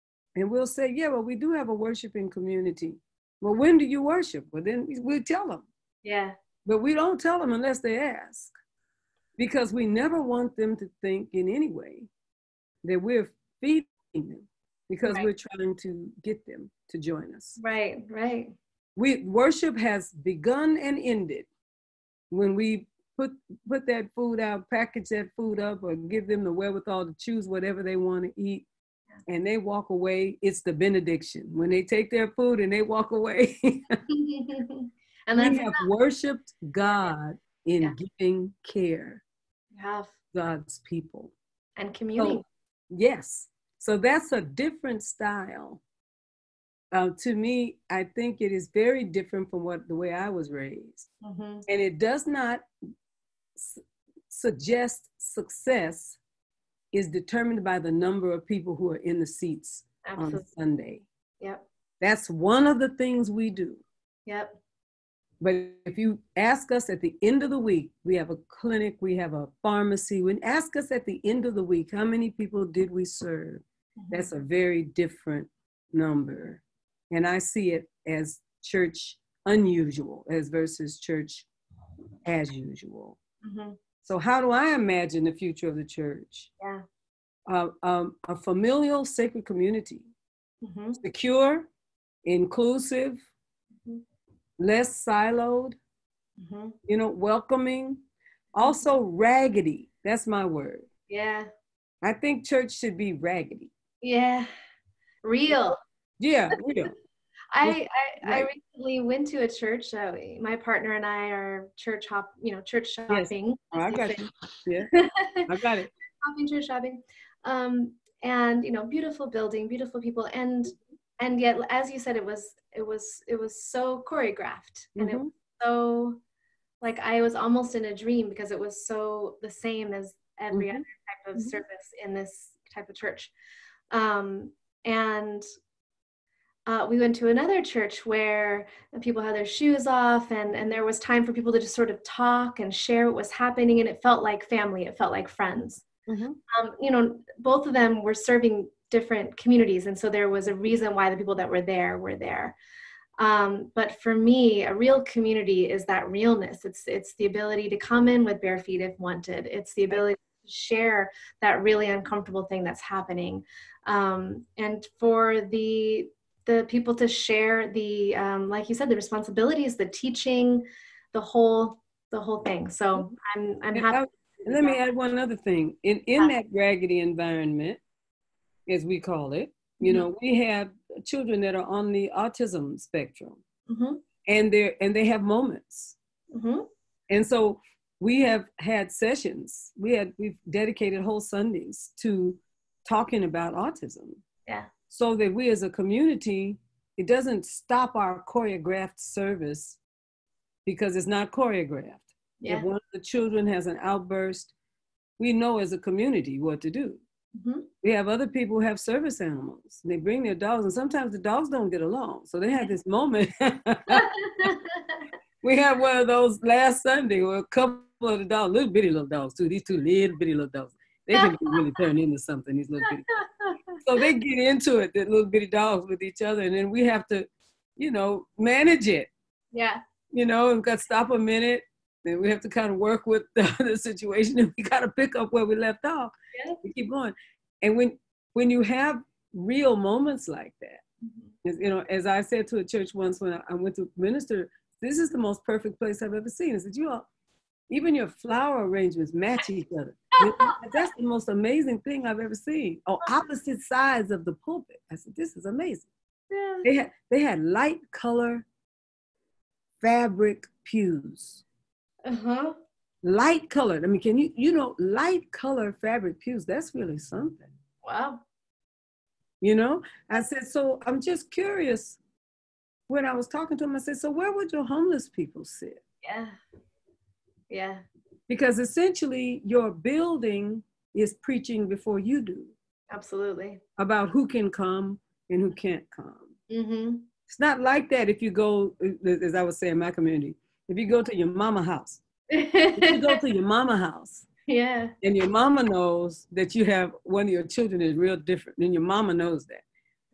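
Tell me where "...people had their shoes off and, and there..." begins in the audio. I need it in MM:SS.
02:18.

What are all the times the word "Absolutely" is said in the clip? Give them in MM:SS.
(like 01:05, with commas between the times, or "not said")
01:00, 04:42.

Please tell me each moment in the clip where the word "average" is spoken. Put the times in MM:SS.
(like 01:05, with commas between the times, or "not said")
not said.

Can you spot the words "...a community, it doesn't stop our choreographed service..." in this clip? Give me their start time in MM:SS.
03:15.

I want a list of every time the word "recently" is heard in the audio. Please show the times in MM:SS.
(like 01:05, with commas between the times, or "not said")
01:48.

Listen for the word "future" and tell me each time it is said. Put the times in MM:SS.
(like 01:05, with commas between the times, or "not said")
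01:25.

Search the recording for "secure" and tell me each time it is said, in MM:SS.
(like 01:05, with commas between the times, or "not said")
01:30.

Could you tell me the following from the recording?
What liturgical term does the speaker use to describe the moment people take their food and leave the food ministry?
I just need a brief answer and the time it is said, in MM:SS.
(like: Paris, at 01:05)
benediction, at 00:30.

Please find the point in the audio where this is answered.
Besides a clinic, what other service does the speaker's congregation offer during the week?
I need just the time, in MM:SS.
01:09.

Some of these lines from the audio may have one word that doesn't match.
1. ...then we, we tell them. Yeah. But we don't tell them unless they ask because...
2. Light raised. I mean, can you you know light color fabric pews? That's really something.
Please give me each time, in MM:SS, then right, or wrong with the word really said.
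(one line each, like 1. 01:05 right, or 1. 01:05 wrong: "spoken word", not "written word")
1. 00:04 right
2. 04:23 wrong: "colored", not "raised".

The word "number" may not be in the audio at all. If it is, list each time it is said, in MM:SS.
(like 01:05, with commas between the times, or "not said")
00:57, 01:15.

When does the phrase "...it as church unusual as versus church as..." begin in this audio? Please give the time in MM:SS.
01:17.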